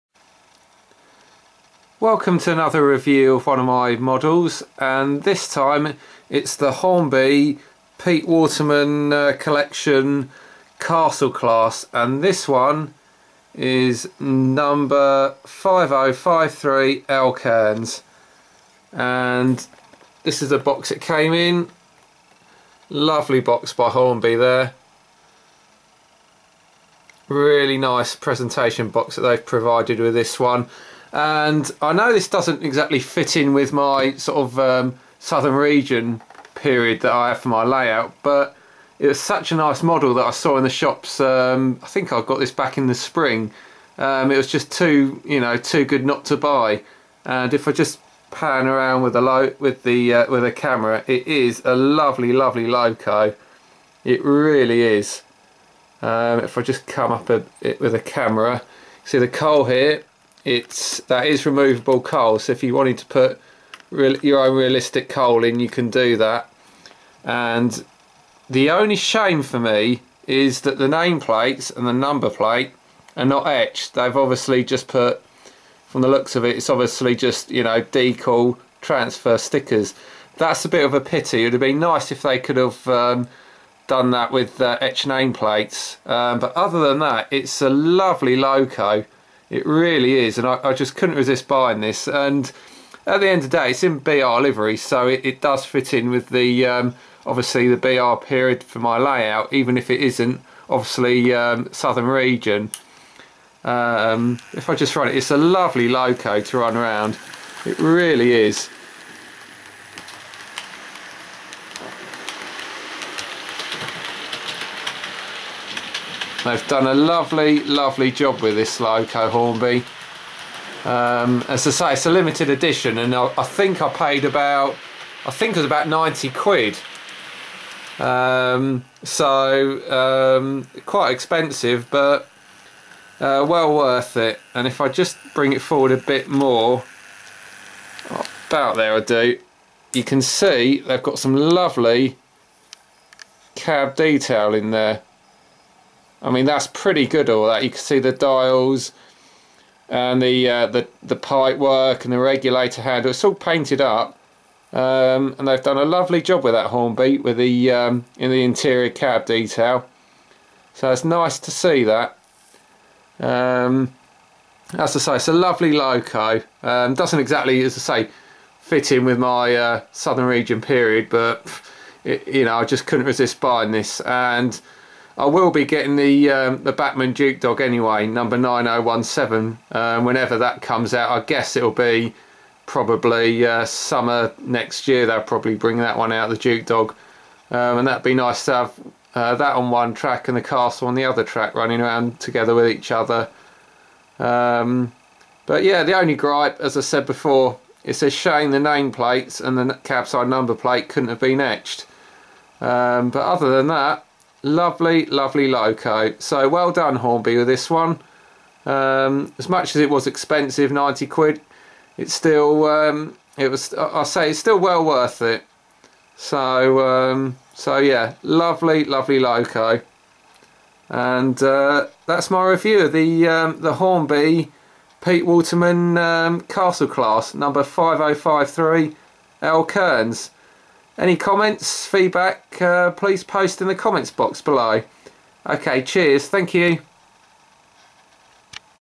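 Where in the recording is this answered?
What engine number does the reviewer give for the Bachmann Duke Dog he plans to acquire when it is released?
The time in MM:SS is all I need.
02:58.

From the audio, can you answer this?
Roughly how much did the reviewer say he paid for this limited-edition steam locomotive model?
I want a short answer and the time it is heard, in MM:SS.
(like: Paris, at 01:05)
90 quid, at 02:05.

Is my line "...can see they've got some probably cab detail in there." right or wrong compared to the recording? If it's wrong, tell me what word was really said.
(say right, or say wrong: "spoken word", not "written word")
wrong: "lovely", not "probably".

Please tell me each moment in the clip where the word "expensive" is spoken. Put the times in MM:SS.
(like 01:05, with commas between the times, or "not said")
02:11, 03:30.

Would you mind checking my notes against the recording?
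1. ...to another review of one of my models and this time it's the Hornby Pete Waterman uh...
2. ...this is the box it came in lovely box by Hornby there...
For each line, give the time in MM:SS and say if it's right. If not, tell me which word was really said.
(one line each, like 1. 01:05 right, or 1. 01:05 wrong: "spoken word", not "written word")
1. 00:02 right
2. 00:20 right.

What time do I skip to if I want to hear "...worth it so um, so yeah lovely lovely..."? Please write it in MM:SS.
03:34.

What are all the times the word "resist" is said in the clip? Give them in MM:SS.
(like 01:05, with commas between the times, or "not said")
01:31, 02:53.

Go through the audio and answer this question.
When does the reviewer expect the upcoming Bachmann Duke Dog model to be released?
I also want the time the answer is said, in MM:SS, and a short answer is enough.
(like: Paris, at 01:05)
summer next year, at 03:03.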